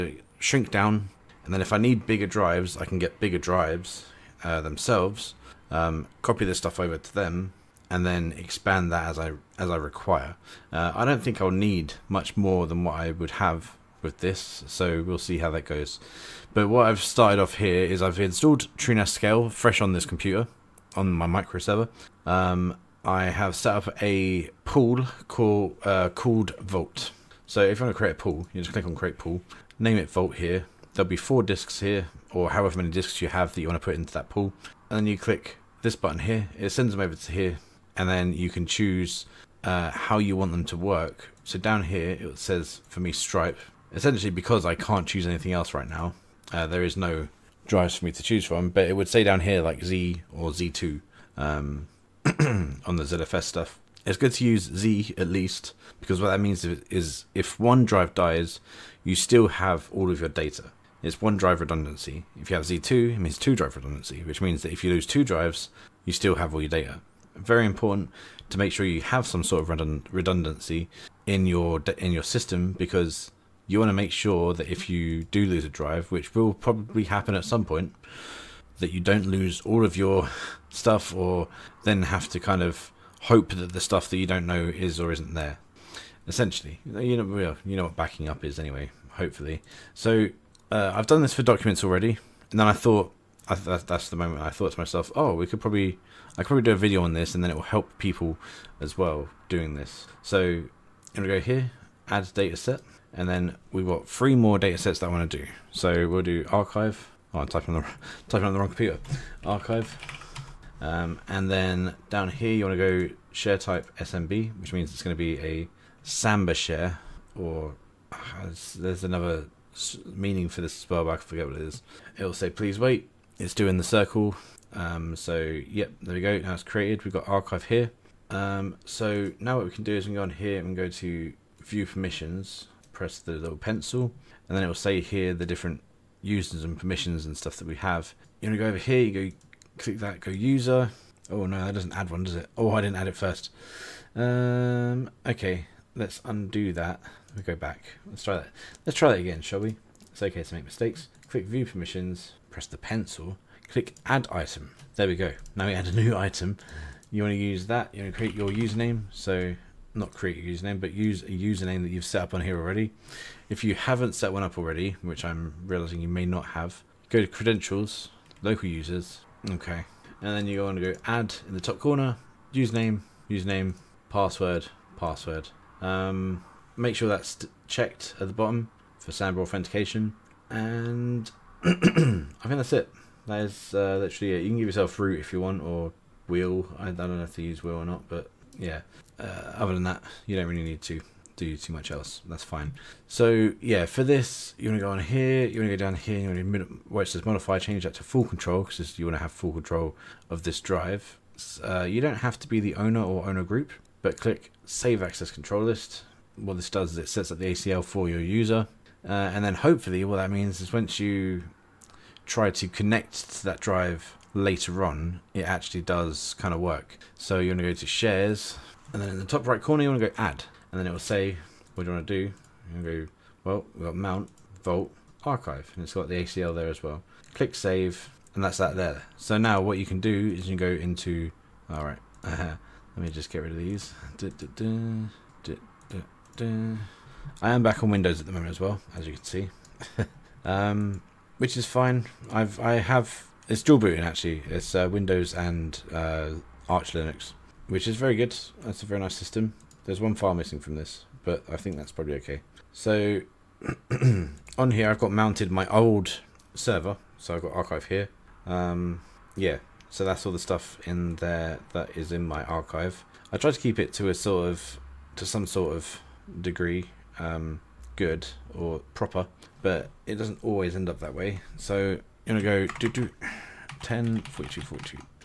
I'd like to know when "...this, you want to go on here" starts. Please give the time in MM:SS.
03:14.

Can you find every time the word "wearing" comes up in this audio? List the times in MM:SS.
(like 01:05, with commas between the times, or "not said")
not said.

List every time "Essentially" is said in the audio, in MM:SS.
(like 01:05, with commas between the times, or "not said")
00:43, 01:26.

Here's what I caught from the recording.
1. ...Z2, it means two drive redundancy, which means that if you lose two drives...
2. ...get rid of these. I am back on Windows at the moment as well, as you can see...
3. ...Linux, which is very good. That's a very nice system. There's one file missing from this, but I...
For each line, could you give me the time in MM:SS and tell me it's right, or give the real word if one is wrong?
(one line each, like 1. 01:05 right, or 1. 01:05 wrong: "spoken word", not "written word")
1. 01:02 right
2. 03:53 right
3. 04:06 right.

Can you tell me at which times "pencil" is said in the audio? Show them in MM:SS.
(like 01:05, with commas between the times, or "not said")
02:13, 02:32.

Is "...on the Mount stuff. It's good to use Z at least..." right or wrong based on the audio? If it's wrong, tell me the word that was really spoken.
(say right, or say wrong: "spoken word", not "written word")
wrong: "ZFS", not "Mount".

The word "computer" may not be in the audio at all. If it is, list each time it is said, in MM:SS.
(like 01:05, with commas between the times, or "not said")
00:20, 01:48.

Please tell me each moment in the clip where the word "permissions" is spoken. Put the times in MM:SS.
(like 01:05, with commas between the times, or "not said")
02:11, 02:16, 02:31.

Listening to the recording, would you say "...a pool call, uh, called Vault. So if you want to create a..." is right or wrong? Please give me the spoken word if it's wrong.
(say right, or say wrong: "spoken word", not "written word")
right.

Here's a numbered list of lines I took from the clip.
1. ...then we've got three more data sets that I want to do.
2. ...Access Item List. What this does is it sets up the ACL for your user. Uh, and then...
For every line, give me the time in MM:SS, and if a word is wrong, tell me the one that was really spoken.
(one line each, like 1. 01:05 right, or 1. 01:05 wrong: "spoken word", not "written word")
1. 01:43 right
2. 03:25 wrong: "Control", not "Item".